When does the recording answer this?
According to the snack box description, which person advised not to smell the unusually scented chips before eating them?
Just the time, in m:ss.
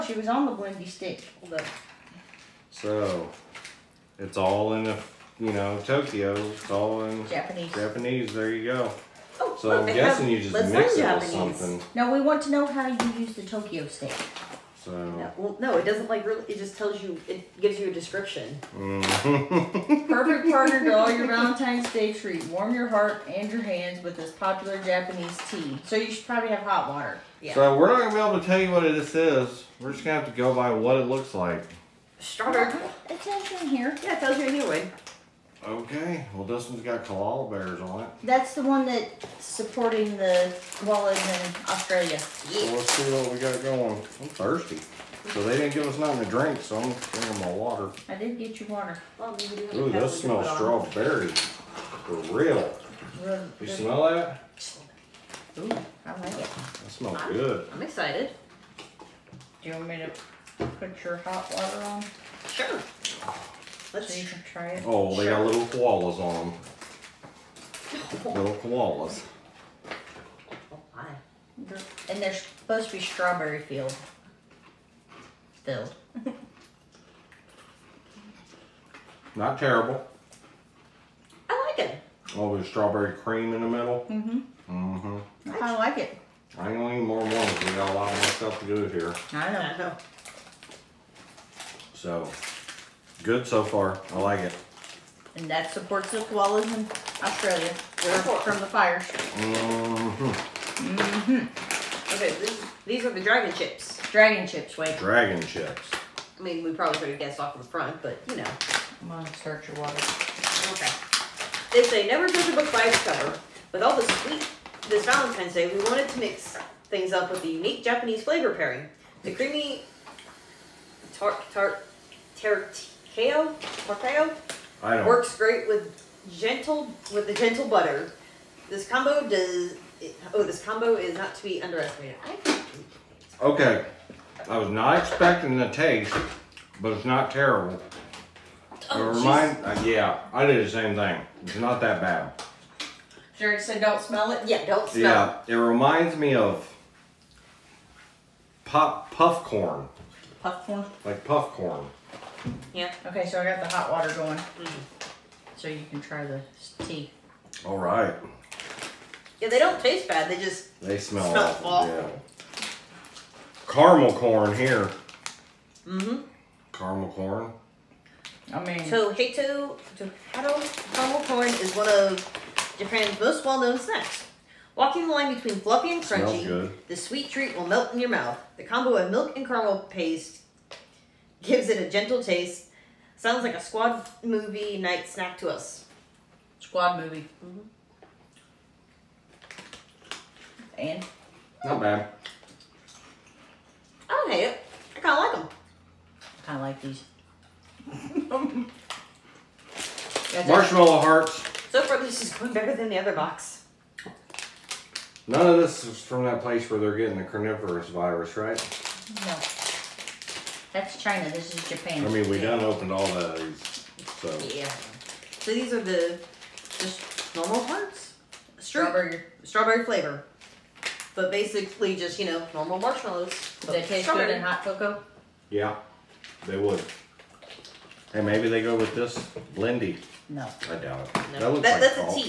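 2:23.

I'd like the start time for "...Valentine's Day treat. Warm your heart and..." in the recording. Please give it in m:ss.
0:21.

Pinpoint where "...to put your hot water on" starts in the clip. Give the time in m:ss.
0:59.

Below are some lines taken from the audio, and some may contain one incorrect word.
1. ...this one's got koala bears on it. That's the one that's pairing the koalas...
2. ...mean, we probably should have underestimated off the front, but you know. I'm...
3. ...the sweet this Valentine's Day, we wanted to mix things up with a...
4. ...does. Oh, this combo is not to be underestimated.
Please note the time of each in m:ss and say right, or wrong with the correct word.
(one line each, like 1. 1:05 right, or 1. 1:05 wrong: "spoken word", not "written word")
1. 0:36 wrong: "supporting", not "pairing"
2. 1:46 wrong: "guessed", not "underestimated"
3. 1:53 right
4. 2:09 right.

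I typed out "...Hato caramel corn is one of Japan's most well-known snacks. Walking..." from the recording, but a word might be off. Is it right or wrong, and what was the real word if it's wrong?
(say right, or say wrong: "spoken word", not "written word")
right.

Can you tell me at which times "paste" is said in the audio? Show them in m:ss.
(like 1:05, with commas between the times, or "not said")
2:59.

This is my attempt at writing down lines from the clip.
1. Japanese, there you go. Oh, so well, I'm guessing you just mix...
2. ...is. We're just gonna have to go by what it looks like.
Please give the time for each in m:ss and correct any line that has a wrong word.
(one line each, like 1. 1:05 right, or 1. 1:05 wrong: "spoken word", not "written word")
1. 0:07 right
2. 0:29 right.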